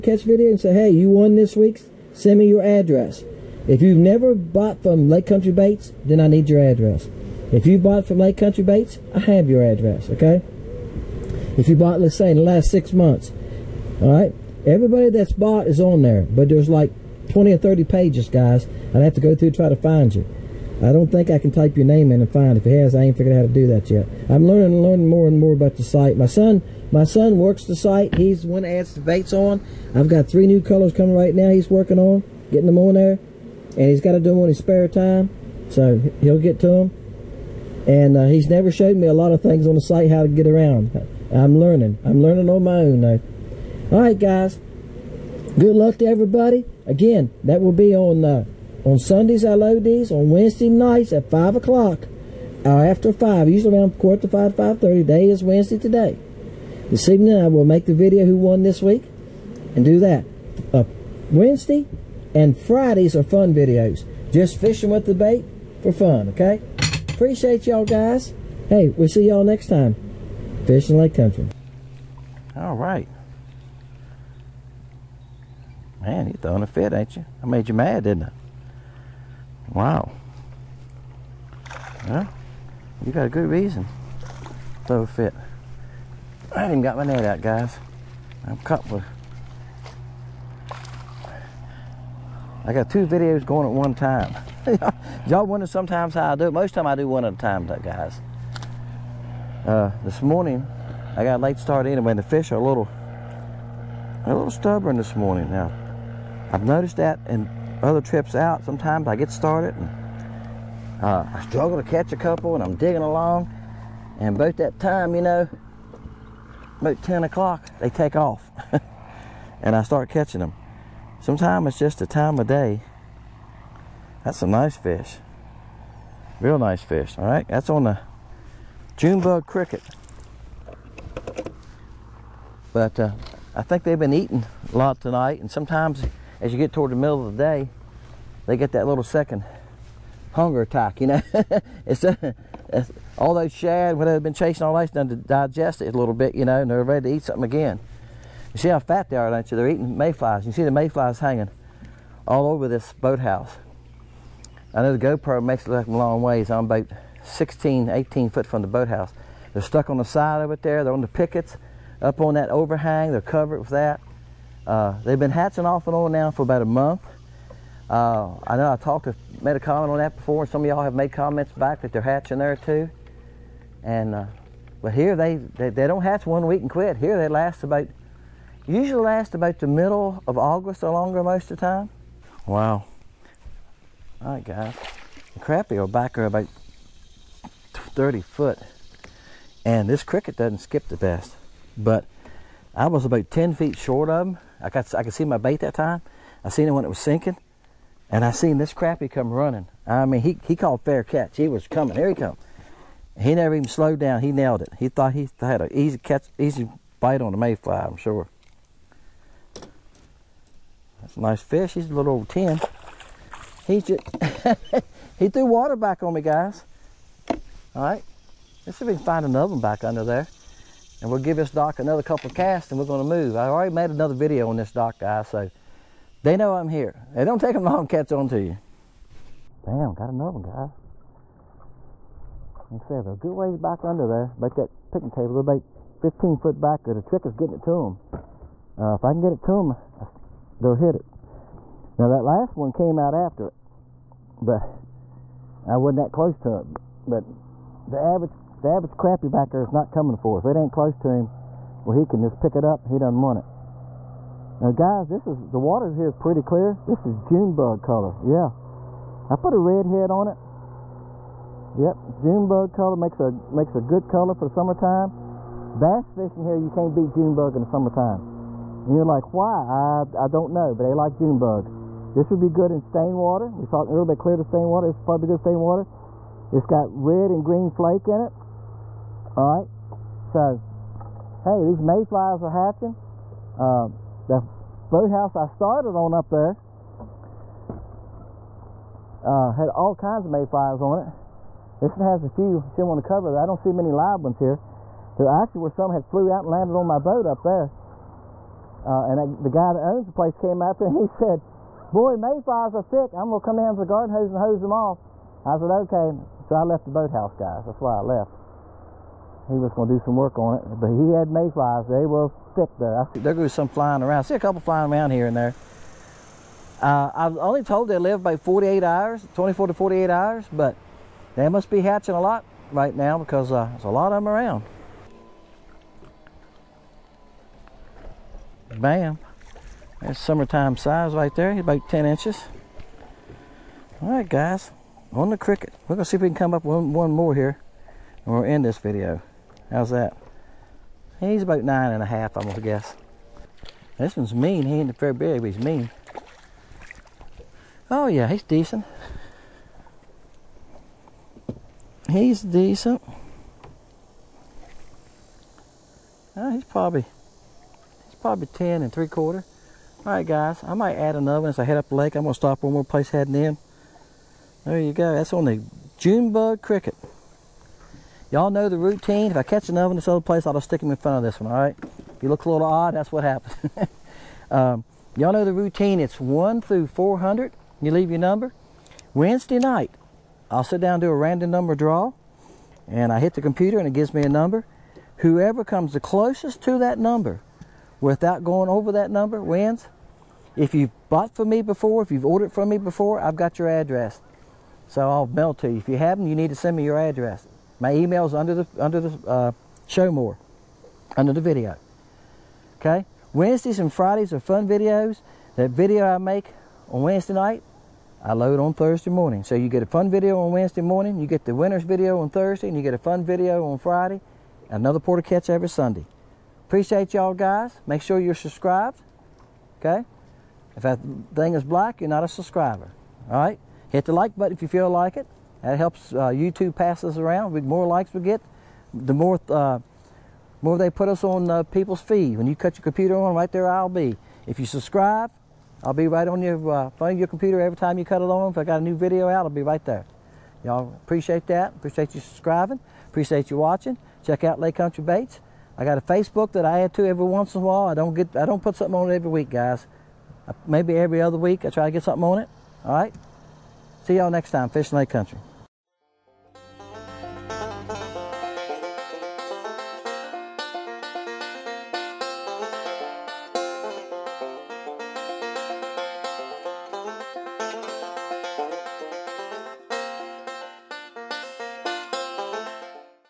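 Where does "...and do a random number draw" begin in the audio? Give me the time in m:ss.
6:20.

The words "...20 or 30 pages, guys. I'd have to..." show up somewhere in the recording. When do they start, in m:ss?
0:17.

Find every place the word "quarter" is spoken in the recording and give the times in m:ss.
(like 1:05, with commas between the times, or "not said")
0:53, 5:59.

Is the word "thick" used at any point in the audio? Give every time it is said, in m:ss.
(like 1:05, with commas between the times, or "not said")
5:02, 5:12.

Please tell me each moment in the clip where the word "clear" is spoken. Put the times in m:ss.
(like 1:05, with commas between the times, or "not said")
4:16, 4:34.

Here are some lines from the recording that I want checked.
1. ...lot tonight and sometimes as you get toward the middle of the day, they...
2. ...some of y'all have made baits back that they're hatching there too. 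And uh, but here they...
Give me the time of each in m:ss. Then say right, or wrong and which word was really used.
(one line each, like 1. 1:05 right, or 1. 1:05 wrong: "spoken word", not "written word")
1. 2:14 right
2. 2:50 wrong: "comments", not "baits".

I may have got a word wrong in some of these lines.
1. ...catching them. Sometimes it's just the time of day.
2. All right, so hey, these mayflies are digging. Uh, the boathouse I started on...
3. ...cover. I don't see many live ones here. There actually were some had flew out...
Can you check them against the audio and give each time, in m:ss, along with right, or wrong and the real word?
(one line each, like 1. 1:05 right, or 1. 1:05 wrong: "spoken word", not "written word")
1. 2:00 right
2. 4:39 wrong: "hatching", not "digging"
3. 4:53 right.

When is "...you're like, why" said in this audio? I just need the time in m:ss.
4:28.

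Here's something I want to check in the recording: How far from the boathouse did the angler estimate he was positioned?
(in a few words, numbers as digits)
16 to 18 feet.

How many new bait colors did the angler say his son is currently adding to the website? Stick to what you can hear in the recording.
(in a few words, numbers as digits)
3.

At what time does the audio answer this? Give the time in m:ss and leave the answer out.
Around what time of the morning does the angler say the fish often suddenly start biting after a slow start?
1:56.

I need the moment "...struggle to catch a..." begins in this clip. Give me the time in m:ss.
1:51.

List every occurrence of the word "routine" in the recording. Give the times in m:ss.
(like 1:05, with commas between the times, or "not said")
6:08, 6:15.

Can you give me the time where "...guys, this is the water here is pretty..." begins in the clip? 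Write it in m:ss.
4:14.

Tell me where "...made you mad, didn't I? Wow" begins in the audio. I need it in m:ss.
1:17.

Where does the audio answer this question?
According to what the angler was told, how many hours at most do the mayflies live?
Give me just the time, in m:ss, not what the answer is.
5:19.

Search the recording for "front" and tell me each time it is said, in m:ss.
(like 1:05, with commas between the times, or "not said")
6:10, 7:16.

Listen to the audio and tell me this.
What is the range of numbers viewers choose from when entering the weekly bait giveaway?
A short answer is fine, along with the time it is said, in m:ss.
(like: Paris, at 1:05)
1 through 400, at 6:16.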